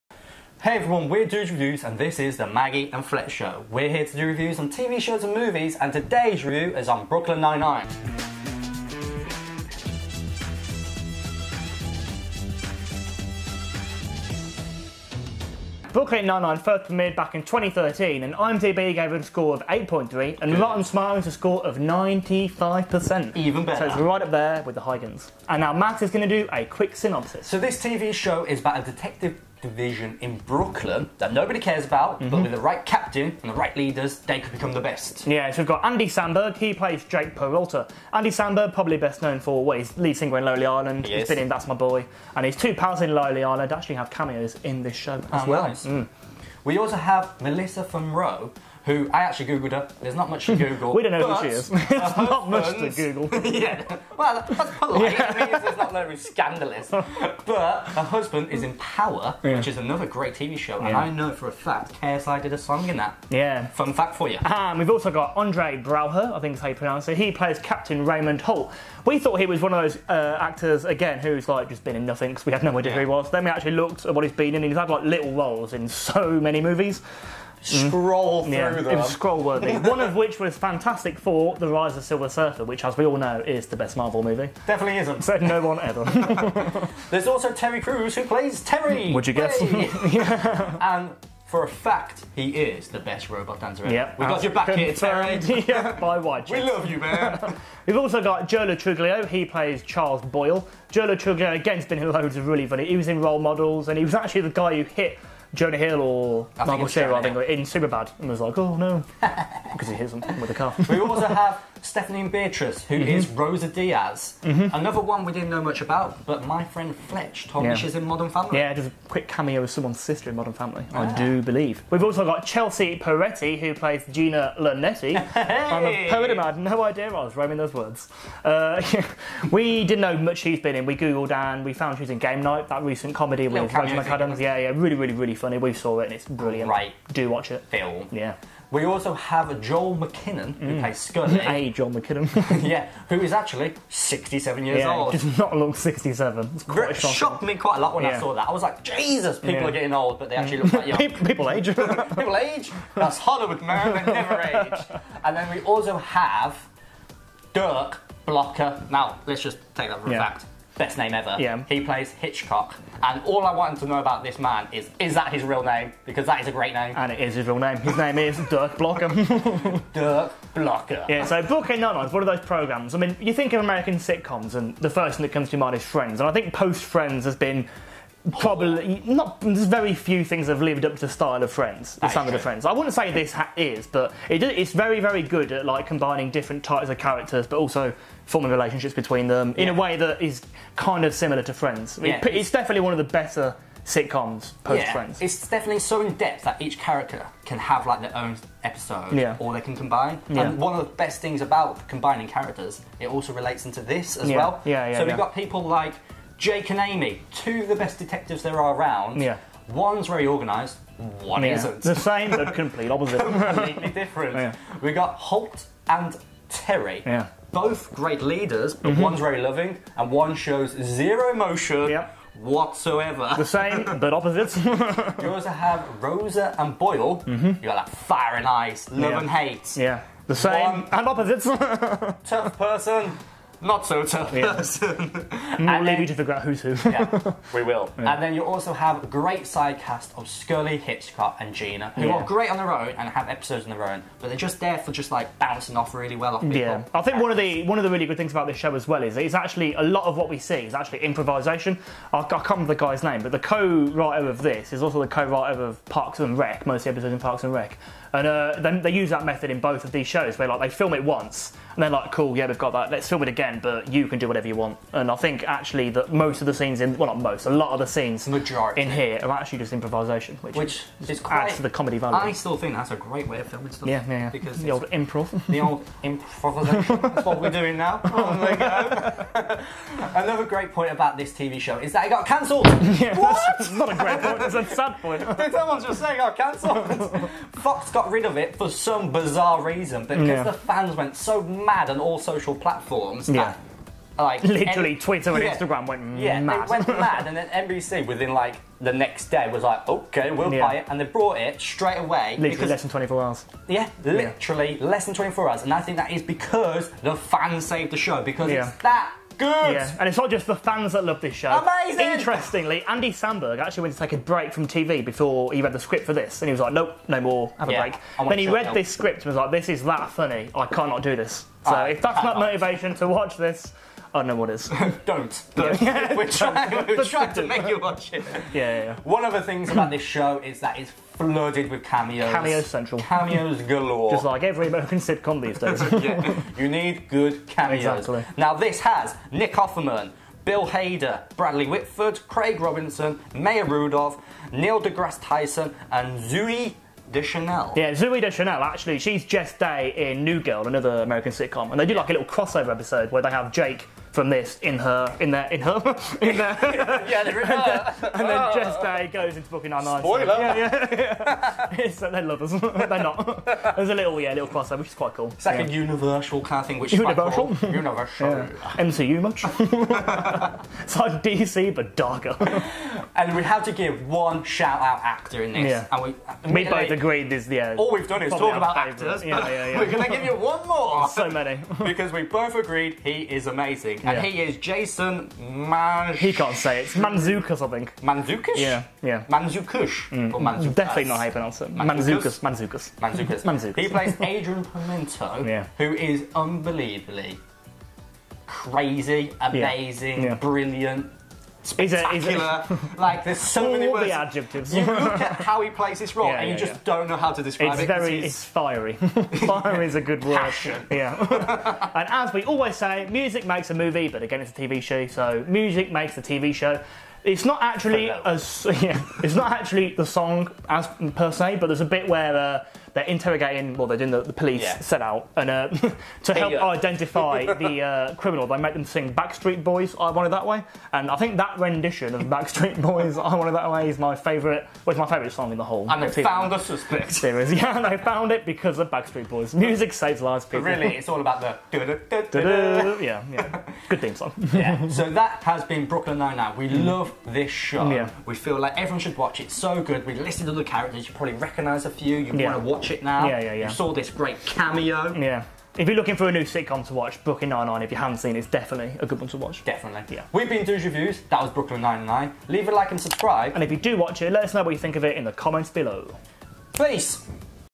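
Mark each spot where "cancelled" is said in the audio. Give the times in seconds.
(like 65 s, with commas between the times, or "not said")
282 s, 286 s.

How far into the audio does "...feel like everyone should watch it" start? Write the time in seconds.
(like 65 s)
448 s.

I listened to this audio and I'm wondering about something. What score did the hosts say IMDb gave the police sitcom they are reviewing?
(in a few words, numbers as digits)
8.3.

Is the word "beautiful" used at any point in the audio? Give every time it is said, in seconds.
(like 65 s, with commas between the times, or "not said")
not said.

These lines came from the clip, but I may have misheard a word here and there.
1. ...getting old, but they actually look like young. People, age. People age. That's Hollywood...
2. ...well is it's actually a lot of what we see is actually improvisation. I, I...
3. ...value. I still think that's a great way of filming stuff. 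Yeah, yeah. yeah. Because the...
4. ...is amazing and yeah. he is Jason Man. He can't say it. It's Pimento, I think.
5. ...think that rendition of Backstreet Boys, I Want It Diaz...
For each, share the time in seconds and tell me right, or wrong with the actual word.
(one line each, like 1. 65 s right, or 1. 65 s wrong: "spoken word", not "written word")
1. 149 s right
2. 248 s right
3. 271 s right
4. 383 s wrong: "Manzukas", not "Pimento"
5. 431 s wrong: "That", not "Diaz".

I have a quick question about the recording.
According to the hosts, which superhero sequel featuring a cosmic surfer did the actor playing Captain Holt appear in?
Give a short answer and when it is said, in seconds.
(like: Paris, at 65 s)
Fantastic Four The Rise of Silver Surfer, at 80 s.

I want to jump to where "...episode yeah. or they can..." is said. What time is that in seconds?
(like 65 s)
198 s.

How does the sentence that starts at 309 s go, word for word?
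Yeah, and it's not just the fans that love this show.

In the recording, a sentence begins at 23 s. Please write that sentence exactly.
So it's right up there with the Higgins.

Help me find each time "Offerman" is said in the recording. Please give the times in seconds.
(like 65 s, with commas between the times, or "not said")
339 s.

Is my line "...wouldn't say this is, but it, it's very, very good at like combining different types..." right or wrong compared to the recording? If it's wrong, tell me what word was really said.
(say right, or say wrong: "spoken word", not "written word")
right.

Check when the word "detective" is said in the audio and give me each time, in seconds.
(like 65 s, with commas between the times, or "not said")
28 s, 207 s.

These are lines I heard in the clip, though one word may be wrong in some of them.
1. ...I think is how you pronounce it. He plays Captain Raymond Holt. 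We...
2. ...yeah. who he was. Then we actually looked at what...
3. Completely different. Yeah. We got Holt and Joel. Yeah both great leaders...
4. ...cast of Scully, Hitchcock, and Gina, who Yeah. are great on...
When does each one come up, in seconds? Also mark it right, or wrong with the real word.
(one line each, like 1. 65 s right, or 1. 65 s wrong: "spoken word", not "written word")
1. 66 s right
2. 72 s right
3. 213 s wrong: "Terry", not "Joel"
4. 239 s right.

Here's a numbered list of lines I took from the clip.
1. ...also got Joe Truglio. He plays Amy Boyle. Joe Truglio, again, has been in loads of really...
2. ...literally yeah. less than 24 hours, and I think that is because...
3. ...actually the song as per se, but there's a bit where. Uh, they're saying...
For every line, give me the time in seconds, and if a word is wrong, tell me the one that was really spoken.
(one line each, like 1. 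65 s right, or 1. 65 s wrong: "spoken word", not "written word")
1. 97 s wrong: "Charles", not "Amy"
2. 304 s right
3. 419 s wrong: "interrogating", not "saying".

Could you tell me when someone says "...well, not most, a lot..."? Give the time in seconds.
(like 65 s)
266 s.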